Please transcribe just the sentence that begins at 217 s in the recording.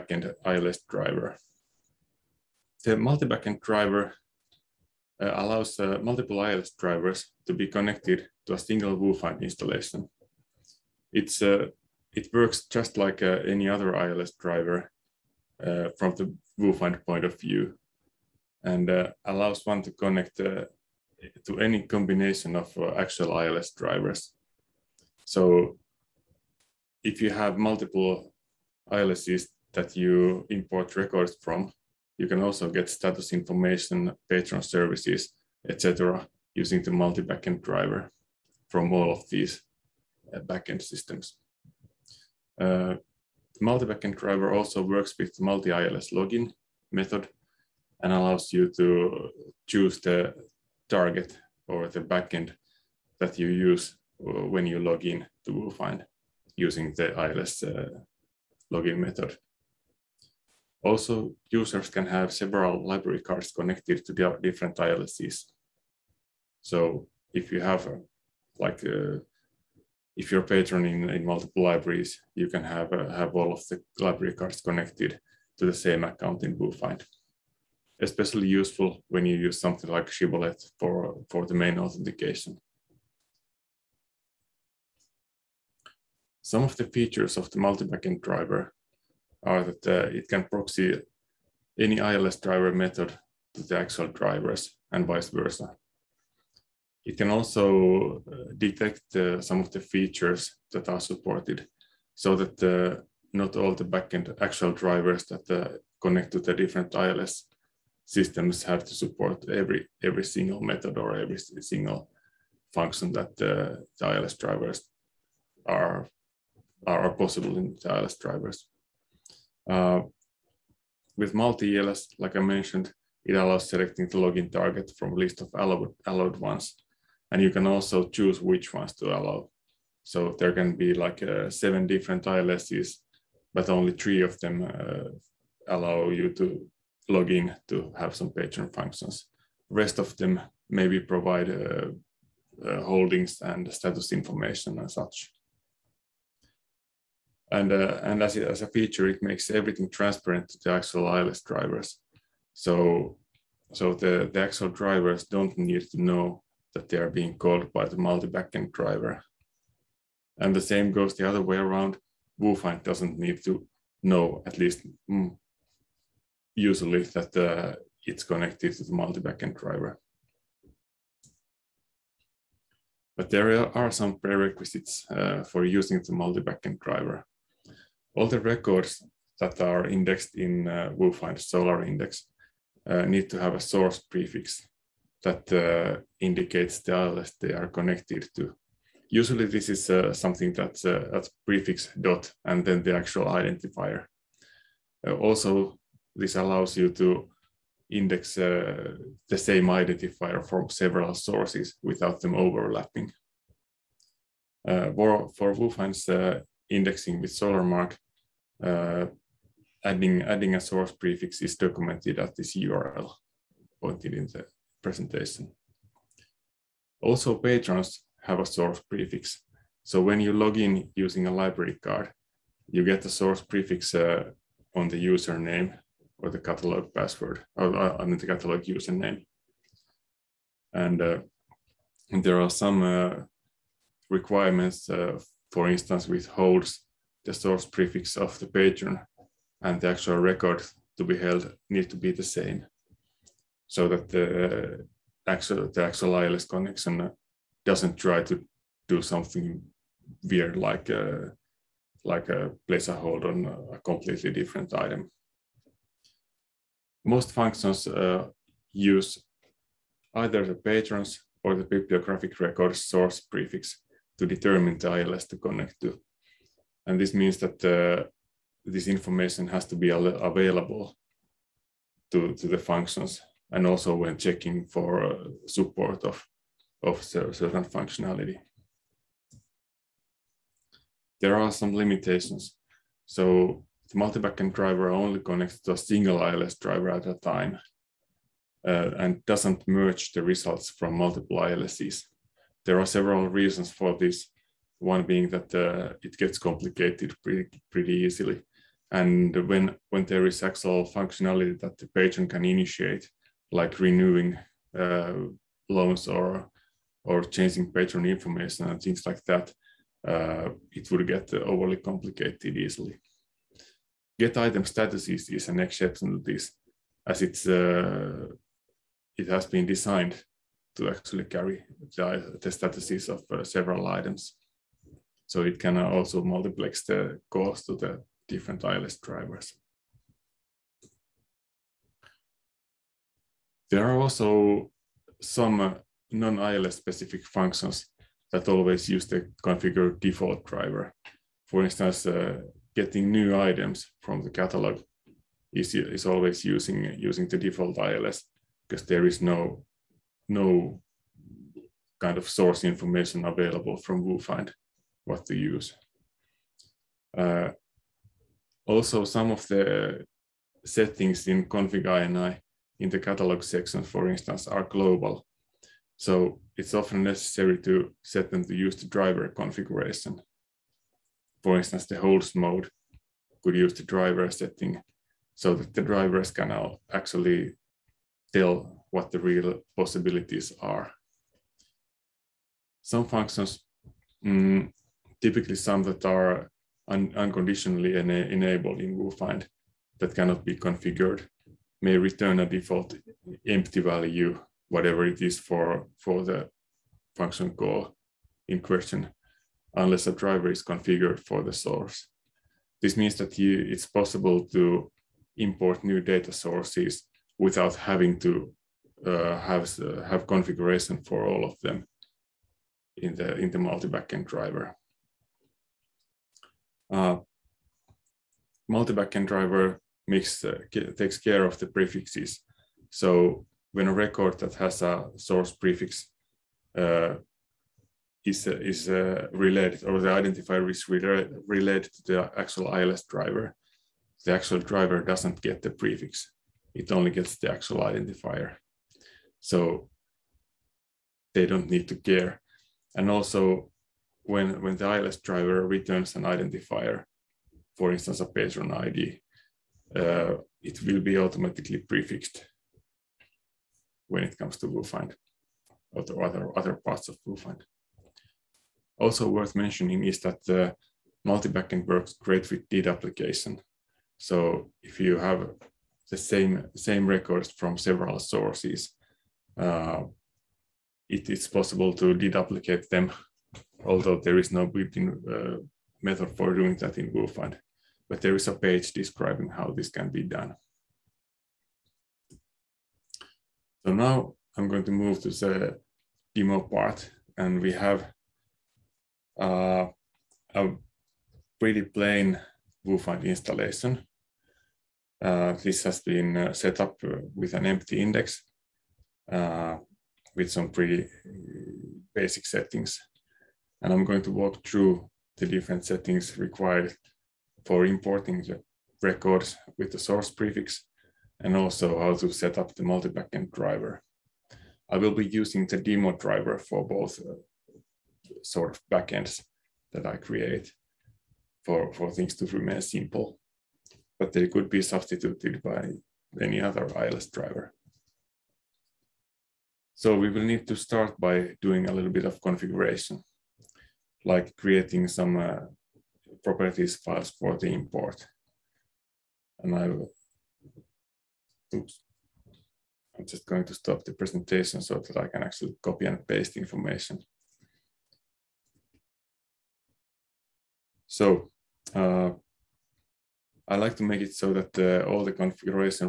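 Also, patrons have a source prefix.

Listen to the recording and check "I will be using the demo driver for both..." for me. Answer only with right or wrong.
right.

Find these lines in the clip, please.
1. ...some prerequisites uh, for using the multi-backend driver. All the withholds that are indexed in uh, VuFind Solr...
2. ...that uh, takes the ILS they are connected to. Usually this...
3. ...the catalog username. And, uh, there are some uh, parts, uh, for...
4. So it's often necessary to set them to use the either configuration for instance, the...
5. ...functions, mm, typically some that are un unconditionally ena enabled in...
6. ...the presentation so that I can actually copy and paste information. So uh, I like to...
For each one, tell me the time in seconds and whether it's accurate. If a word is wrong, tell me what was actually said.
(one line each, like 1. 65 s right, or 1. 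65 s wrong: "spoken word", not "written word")
1. 173 s wrong: "records", not "withholds"
2. 185 s wrong: "indicates", not "takes"
3. 228 s wrong: "requirements", not "parts"
4. 365 s wrong: "driver", not "either"
5. 383 s right
6. 544 s right.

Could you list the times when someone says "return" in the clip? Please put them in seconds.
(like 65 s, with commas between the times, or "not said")
391 s, 445 s.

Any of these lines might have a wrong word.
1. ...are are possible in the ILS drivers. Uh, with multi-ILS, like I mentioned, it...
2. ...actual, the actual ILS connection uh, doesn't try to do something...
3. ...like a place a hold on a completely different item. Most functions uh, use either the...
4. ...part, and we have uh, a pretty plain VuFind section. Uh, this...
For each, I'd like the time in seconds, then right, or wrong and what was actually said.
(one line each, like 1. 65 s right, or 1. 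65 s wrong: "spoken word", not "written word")
1. 115 s right
2. 245 s right
3. 252 s right
4. 486 s wrong: "installation", not "section".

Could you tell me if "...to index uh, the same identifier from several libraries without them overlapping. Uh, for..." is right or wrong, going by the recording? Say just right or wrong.
wrong.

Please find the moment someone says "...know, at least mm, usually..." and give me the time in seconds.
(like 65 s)
164 s.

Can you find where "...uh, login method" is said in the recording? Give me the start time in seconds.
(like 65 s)
57 s.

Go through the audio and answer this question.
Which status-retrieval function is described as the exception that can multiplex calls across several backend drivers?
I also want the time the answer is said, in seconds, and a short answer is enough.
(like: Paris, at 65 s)
get item status, at 314 s.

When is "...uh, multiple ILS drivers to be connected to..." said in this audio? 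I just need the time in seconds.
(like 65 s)
5 s.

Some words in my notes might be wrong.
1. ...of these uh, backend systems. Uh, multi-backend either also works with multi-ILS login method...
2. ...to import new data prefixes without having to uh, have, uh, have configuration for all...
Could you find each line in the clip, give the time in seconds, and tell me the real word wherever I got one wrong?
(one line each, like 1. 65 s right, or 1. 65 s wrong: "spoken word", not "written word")
1. 39 s wrong: "driver", not "either"
2. 404 s wrong: "sources", not "prefixes".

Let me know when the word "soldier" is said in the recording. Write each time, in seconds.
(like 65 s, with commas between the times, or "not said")
not said.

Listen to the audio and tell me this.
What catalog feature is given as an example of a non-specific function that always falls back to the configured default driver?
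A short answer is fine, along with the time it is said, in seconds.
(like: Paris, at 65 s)
getting new items, at 342 s.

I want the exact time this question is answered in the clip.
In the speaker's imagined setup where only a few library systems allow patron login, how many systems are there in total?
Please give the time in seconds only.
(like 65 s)
131 s.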